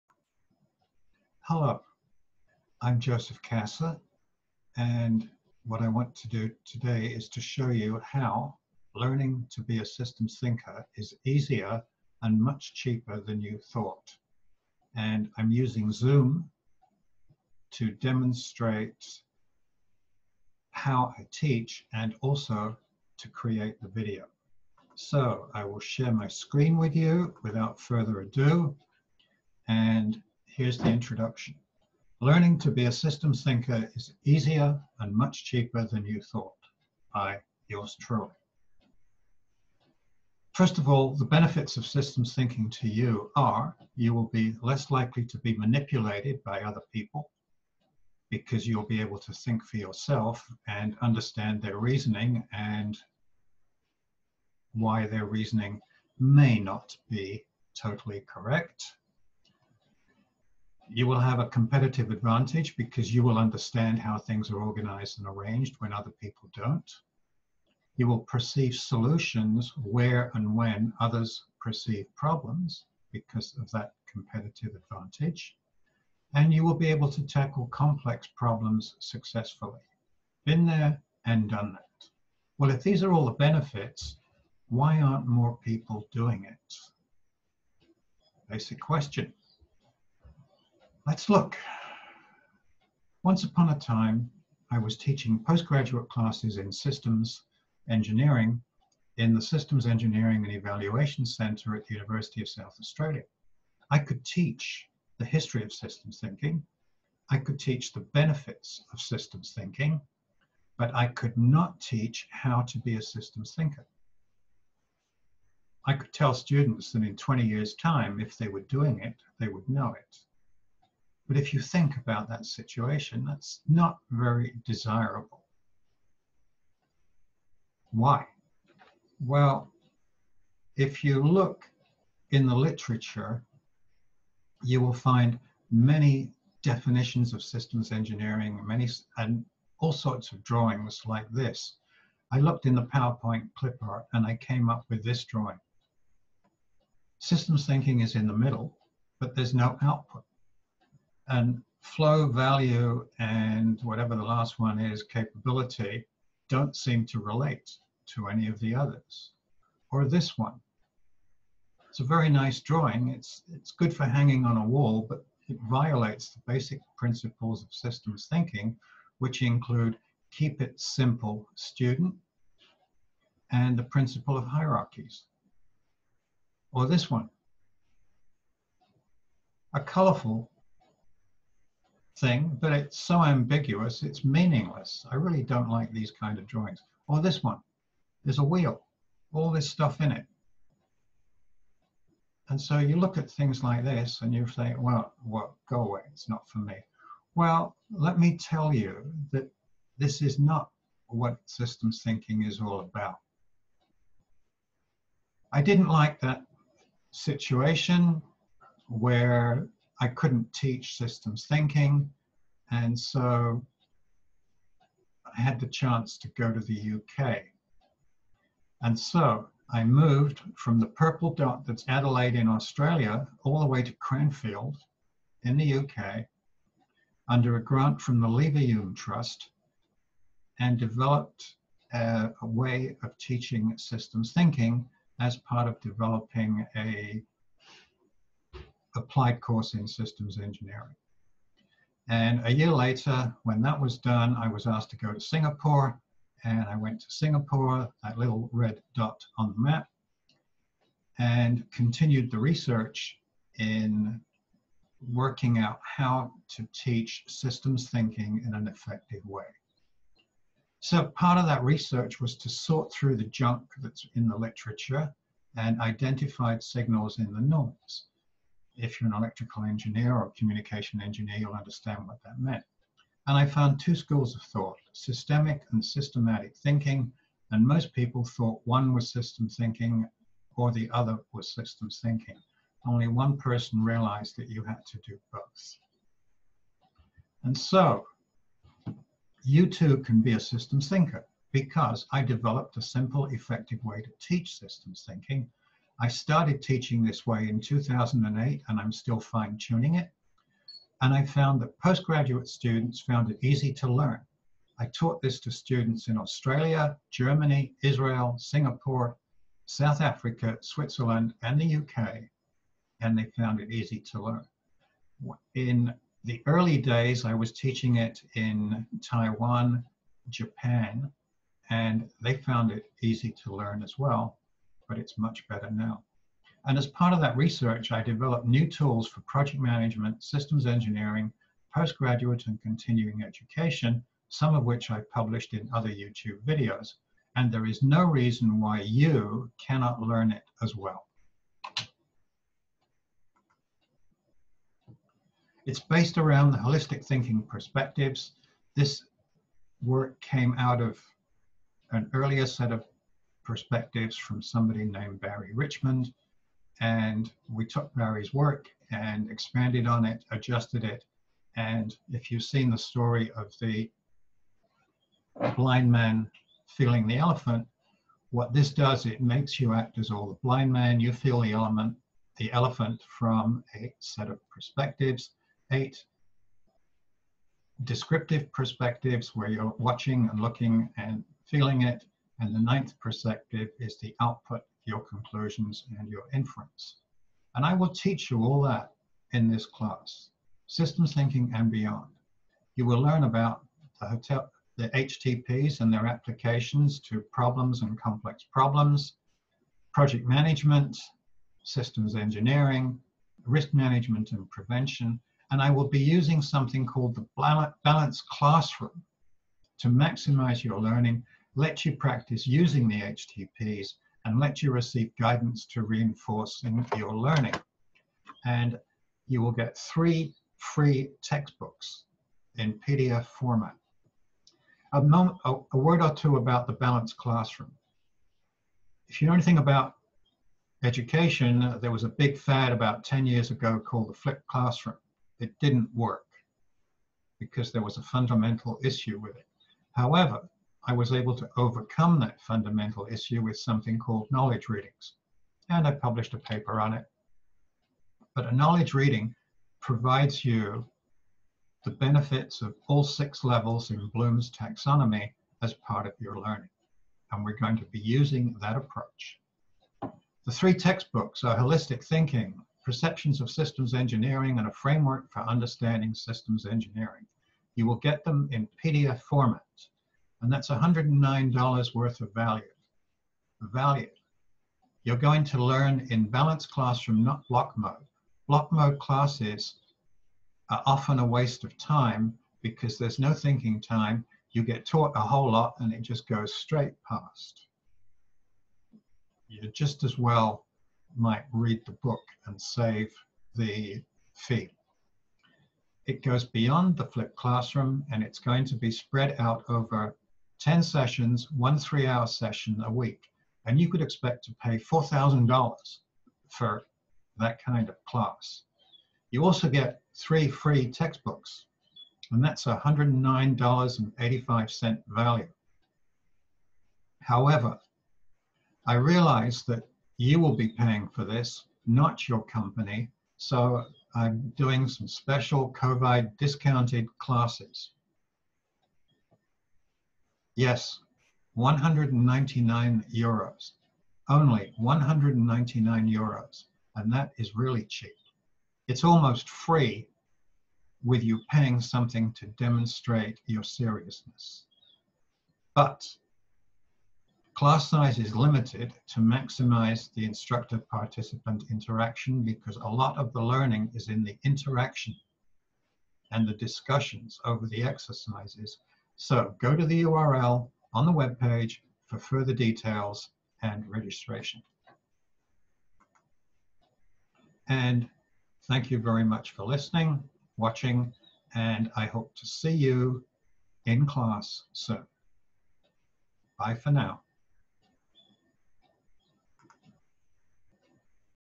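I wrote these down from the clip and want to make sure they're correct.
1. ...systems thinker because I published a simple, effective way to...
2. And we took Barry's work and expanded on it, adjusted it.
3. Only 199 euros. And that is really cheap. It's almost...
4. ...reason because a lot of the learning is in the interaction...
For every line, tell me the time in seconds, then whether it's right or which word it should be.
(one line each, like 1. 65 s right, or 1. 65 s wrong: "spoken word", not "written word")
1. 290 s wrong: "developed", not "published"
2. 356 s right
3. 534 s right
4. 551 s wrong: "interaction", not "reason".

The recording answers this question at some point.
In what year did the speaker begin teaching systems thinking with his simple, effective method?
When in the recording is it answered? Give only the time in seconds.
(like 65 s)
297 s.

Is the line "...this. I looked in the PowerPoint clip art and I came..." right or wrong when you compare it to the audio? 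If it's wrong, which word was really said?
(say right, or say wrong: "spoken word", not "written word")
right.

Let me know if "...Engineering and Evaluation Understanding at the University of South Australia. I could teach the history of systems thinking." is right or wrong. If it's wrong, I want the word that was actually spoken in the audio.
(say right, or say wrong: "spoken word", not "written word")
wrong: "Center", not "Understanding".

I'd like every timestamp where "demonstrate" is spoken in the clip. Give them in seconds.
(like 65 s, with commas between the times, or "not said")
17 s, 542 s.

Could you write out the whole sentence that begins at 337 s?
And there is no reason why you cannot learn it as well.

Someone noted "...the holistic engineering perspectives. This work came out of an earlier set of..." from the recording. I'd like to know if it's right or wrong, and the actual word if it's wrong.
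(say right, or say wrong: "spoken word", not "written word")
wrong: "thinking", not "engineering".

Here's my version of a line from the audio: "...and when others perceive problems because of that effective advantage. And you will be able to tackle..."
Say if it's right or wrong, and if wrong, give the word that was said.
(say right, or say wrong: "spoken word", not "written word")
wrong: "competitive", not "effective".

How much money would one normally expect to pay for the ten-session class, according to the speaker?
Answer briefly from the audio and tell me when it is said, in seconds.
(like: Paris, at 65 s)
$4,000, at 504 s.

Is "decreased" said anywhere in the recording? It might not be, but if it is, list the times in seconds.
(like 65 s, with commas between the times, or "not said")
not said.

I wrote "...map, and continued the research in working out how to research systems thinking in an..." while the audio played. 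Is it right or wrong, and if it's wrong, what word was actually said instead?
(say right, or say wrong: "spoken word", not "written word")
wrong: "teach", not "research".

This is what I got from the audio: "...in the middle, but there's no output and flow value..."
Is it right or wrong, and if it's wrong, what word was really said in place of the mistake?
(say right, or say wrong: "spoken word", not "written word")
right.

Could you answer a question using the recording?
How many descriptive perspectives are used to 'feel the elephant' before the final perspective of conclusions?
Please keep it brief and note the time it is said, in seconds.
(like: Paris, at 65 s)
8, at 375 s.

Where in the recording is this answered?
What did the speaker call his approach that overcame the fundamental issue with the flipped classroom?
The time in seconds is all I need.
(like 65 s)
444 s.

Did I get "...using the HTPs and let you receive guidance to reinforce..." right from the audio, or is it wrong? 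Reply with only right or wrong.
right.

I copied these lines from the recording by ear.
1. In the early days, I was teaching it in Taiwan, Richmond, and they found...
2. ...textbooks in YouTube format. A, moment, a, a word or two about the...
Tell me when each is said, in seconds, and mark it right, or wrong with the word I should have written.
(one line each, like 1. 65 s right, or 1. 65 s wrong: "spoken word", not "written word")
1. 315 s wrong: "Japan", not "Richmond"
2. 421 s wrong: "PDF", not "YouTube".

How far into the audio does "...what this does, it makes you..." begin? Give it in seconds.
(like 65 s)
368 s.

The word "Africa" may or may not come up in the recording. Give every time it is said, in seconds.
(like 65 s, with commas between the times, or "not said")
310 s.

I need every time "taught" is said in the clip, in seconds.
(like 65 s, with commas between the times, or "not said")
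304 s, 484 s.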